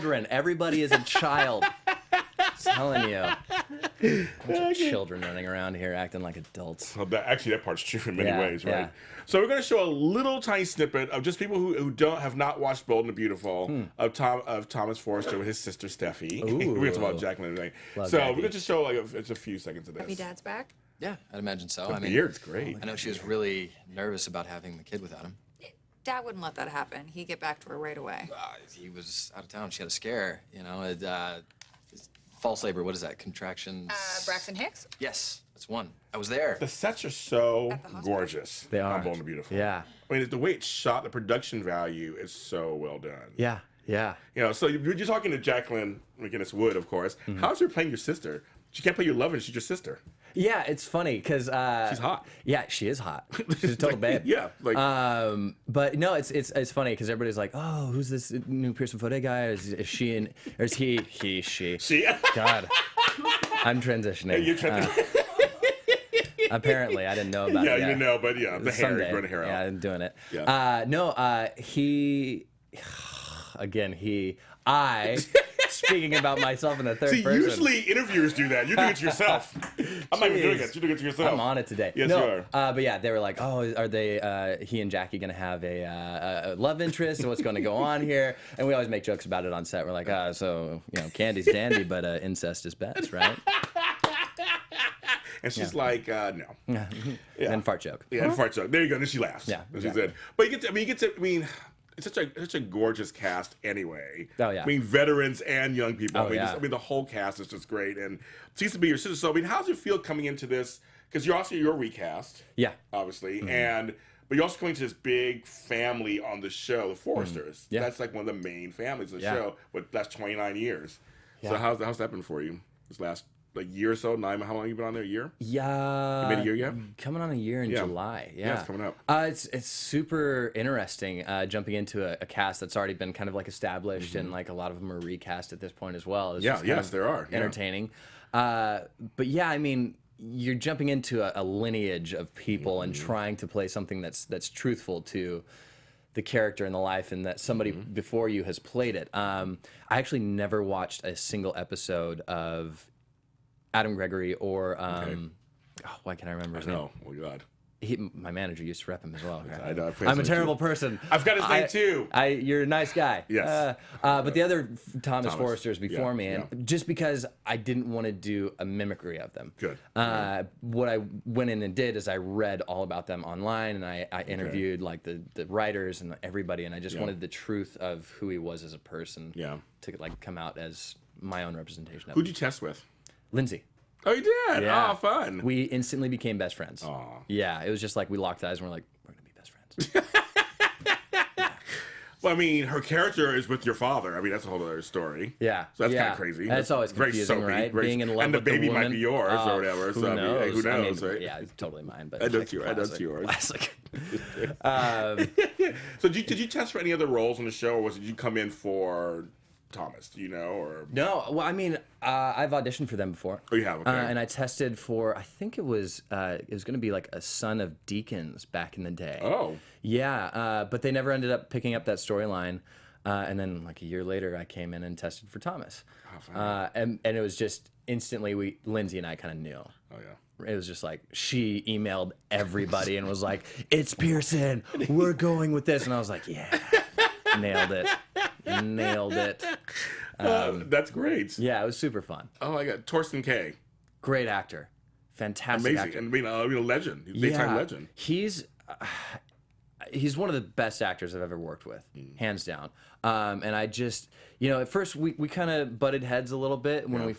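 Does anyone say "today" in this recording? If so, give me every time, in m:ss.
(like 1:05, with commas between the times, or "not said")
0:17, 1:21.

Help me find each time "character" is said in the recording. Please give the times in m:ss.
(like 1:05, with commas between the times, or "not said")
2:26, 3:12.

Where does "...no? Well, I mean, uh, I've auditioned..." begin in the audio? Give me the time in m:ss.
3:30.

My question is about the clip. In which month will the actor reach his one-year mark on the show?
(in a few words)
July.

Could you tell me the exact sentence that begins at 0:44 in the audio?
You know, so you're, you're talking to Jacqueline MacInnes Wood, of course.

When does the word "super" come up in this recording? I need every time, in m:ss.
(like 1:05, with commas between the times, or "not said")
2:09, 4:01.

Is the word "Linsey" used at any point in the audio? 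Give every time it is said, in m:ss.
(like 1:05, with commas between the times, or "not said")
3:03, 3:48.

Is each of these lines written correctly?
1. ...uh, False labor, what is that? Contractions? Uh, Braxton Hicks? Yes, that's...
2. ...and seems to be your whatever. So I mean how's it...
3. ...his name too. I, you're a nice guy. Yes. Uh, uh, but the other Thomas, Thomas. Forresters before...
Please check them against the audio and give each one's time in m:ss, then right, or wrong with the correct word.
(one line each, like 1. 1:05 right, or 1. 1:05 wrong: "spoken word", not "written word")
1. 0:31 right
2. 1:47 wrong: "sister", not "whatever"
3. 2:41 right.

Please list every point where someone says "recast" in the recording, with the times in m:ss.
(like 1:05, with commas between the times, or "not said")
1:51, 2:15.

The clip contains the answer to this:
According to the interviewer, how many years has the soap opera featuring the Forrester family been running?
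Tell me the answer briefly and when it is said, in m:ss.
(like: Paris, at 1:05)
29, at 2:00.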